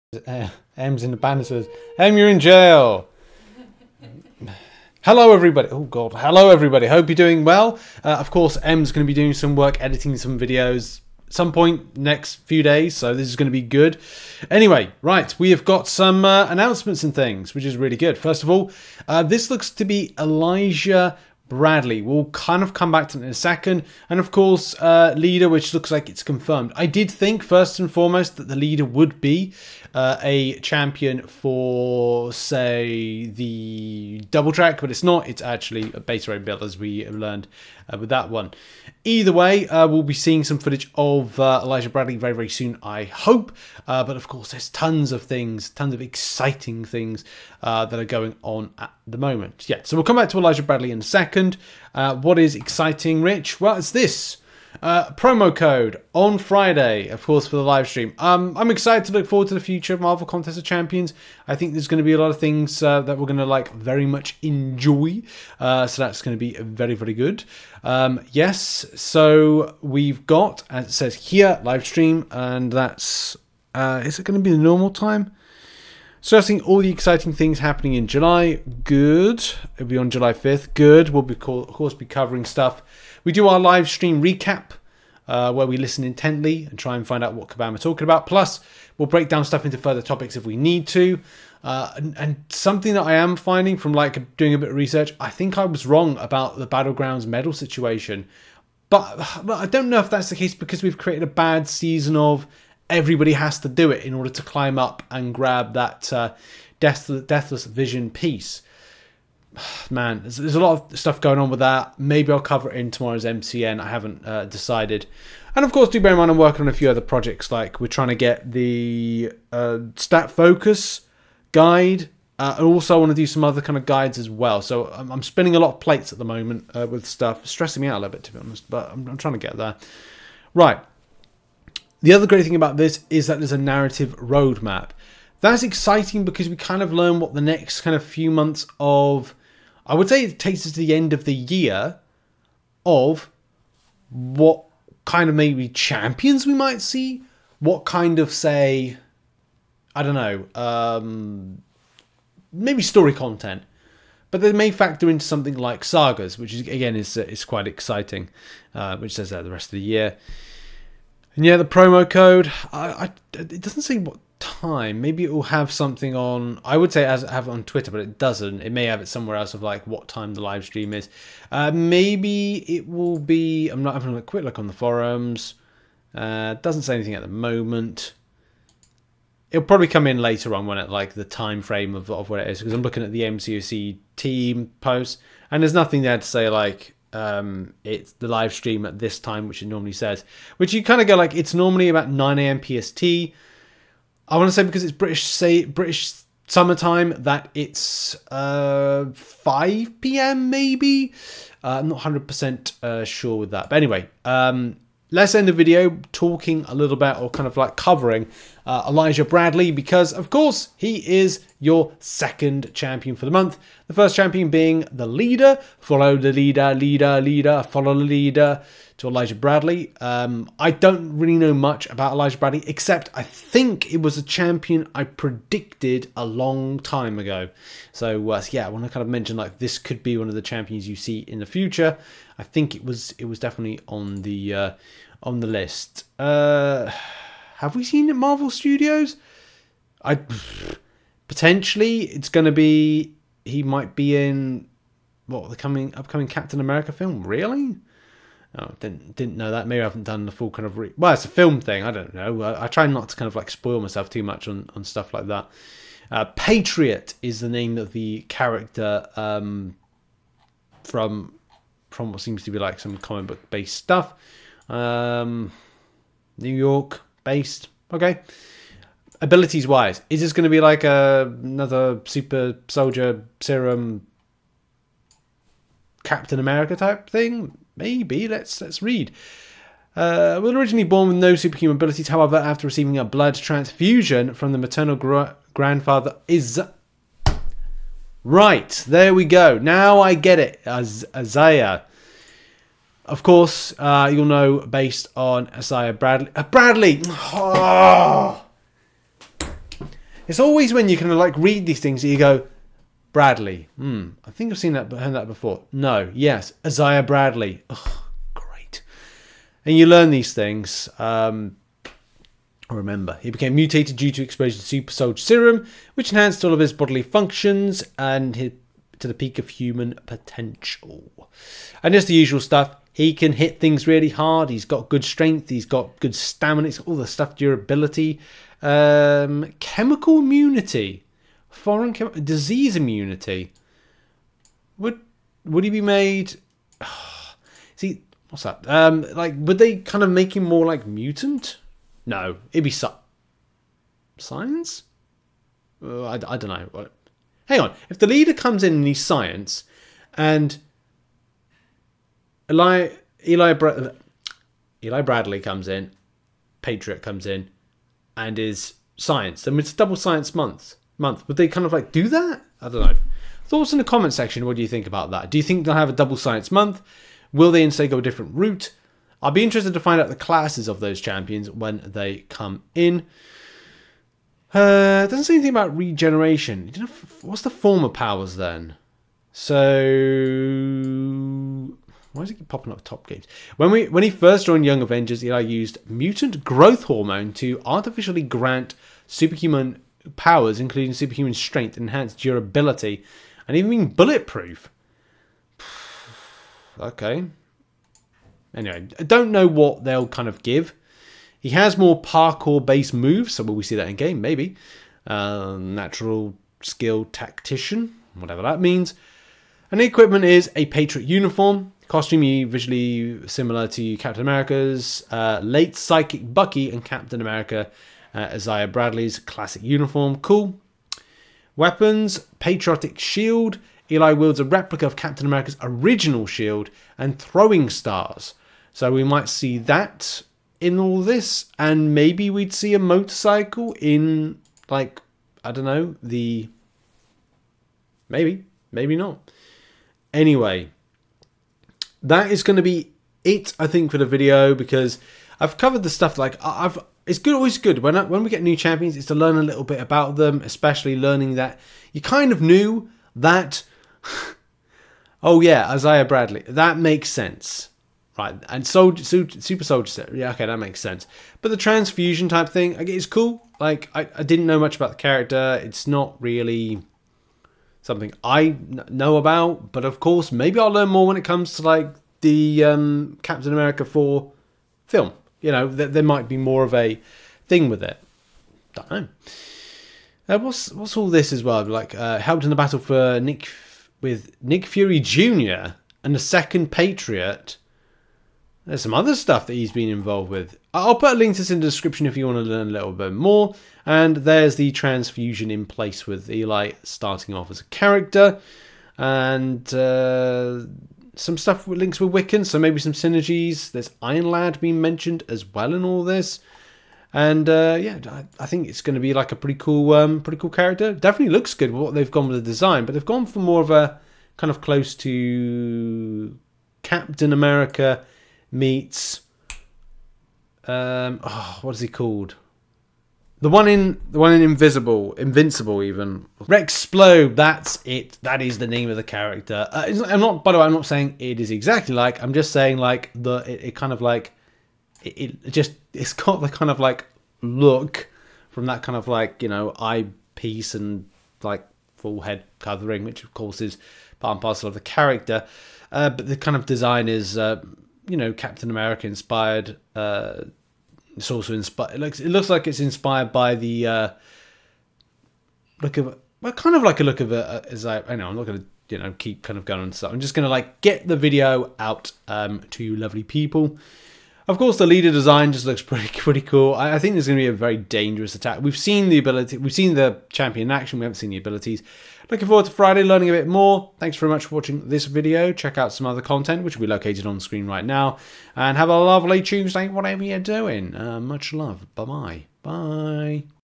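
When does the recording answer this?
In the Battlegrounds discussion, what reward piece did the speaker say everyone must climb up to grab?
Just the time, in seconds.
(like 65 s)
107 s.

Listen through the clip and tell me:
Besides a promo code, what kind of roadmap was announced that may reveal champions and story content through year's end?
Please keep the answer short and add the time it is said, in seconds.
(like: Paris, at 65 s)
narrative roadmap, at 133 s.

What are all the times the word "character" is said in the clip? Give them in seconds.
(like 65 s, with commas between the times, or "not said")
258 s, 464 s, 497 s, 510 s, 529 s, 544 s.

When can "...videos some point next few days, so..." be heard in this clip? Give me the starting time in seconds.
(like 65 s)
10 s.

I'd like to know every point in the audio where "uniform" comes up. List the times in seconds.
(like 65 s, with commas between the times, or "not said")
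411 s, 419 s.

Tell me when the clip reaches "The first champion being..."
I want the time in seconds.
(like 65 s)
213 s.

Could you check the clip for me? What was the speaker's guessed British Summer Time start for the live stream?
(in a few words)
5 p.m.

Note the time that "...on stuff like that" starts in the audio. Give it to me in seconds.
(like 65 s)
254 s.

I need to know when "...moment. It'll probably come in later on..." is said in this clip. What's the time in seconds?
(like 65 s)
177 s.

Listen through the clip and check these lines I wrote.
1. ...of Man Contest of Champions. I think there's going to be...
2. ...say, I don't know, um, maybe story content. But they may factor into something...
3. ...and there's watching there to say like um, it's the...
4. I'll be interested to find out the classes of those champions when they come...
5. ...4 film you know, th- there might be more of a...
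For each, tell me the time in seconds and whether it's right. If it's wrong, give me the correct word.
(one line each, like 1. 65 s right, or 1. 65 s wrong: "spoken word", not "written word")
1. 59 s wrong: "Marvel", not "Man"
2. 148 s right
3. 185 s wrong: "nothing", not "watching"
4. 369 s right
5. 473 s right.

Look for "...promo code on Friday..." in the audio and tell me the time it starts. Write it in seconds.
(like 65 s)
55 s.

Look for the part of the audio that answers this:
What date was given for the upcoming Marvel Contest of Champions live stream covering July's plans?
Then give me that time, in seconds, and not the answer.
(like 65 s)
80 s.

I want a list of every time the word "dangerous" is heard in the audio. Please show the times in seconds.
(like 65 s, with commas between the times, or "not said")
567 s.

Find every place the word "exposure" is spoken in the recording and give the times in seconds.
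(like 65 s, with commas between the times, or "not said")
314 s.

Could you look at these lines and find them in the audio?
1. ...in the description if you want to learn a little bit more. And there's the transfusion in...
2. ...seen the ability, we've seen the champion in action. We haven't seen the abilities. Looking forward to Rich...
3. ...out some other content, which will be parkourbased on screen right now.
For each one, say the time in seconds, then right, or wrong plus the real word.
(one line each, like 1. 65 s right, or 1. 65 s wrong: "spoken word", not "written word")
1. 491 s right
2. 568 s wrong: "Friday", not "Rich"
3. 575 s wrong: "located", not "parkourbased".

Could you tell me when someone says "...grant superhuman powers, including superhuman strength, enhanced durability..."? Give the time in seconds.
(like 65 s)
388 s.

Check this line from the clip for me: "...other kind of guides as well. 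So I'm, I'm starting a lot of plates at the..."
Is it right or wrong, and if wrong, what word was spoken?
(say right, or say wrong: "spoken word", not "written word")
wrong: "spinning", not "starting".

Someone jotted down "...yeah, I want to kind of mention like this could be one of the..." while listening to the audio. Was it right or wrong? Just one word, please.
right.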